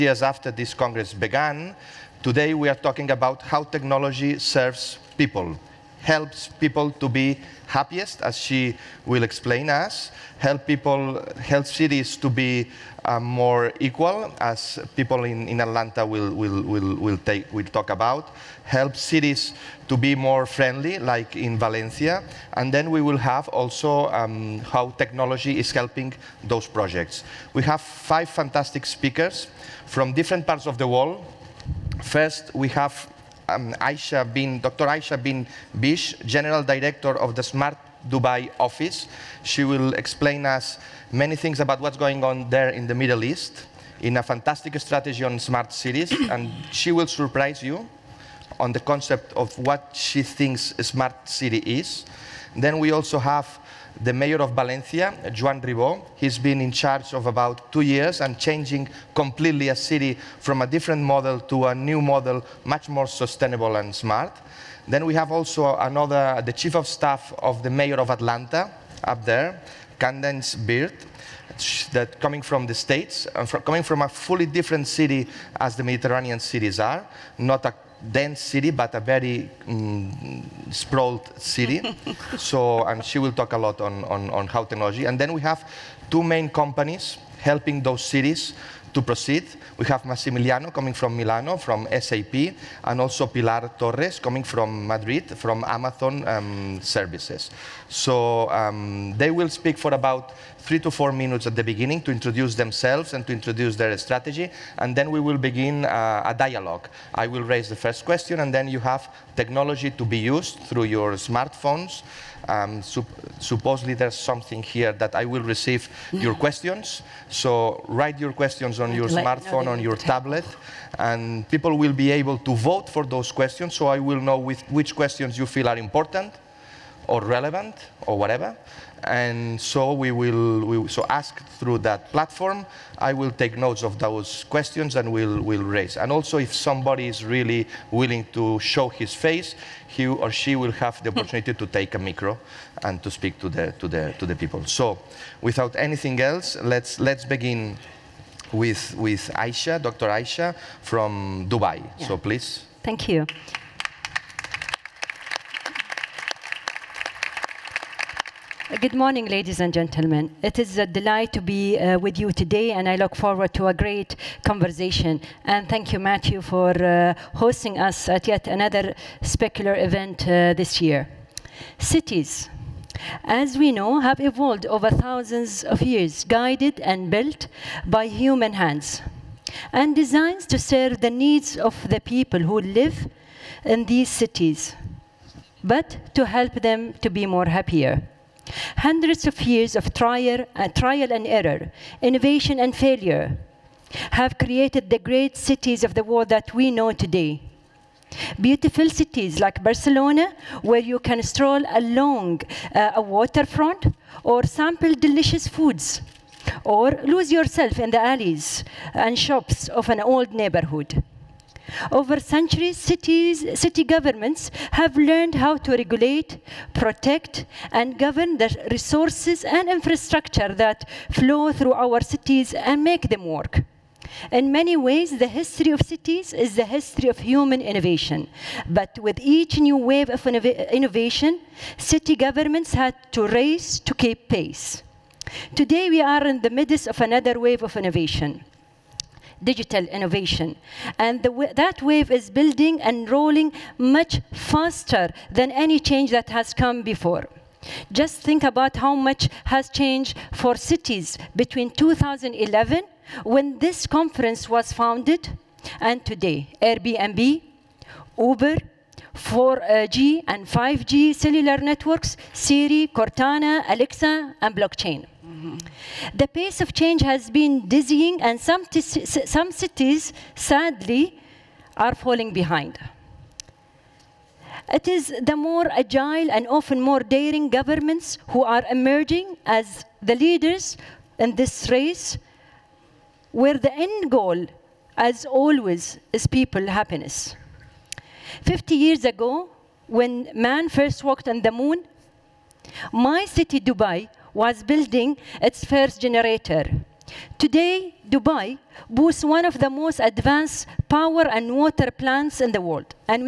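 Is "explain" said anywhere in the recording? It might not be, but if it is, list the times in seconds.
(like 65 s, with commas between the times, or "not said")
9 s, 39 s.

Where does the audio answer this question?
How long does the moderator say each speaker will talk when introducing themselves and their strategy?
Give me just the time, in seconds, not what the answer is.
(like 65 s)
100 s.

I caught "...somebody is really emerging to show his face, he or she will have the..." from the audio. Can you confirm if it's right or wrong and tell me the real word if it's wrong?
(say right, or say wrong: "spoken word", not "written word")
wrong: "willing", not "emerging".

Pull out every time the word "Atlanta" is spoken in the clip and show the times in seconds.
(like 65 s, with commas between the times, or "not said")
15 s, 68 s.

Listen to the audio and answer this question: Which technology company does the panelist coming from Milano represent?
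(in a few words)
SAP.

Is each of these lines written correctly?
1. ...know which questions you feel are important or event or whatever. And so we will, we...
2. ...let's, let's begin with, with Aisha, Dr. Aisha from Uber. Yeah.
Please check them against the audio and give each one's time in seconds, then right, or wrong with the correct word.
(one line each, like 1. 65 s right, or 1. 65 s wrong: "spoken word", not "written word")
1. 124 s wrong: "relevant", not "event"
2. 146 s wrong: "Dubai", not "Uber".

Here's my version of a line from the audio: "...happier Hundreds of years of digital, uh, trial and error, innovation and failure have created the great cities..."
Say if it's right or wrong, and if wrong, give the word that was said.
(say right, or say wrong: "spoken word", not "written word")
wrong: "trial", not "digital".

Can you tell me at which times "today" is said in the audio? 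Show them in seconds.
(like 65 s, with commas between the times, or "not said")
2 s, 162 s, 196 s, 235 s, 256 s, 297 s.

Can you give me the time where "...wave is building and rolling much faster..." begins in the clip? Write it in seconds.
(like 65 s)
241 s.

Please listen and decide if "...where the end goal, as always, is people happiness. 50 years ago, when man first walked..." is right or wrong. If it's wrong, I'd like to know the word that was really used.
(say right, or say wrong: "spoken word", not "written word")
right.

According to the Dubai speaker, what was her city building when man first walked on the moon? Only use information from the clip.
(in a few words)
its first generator.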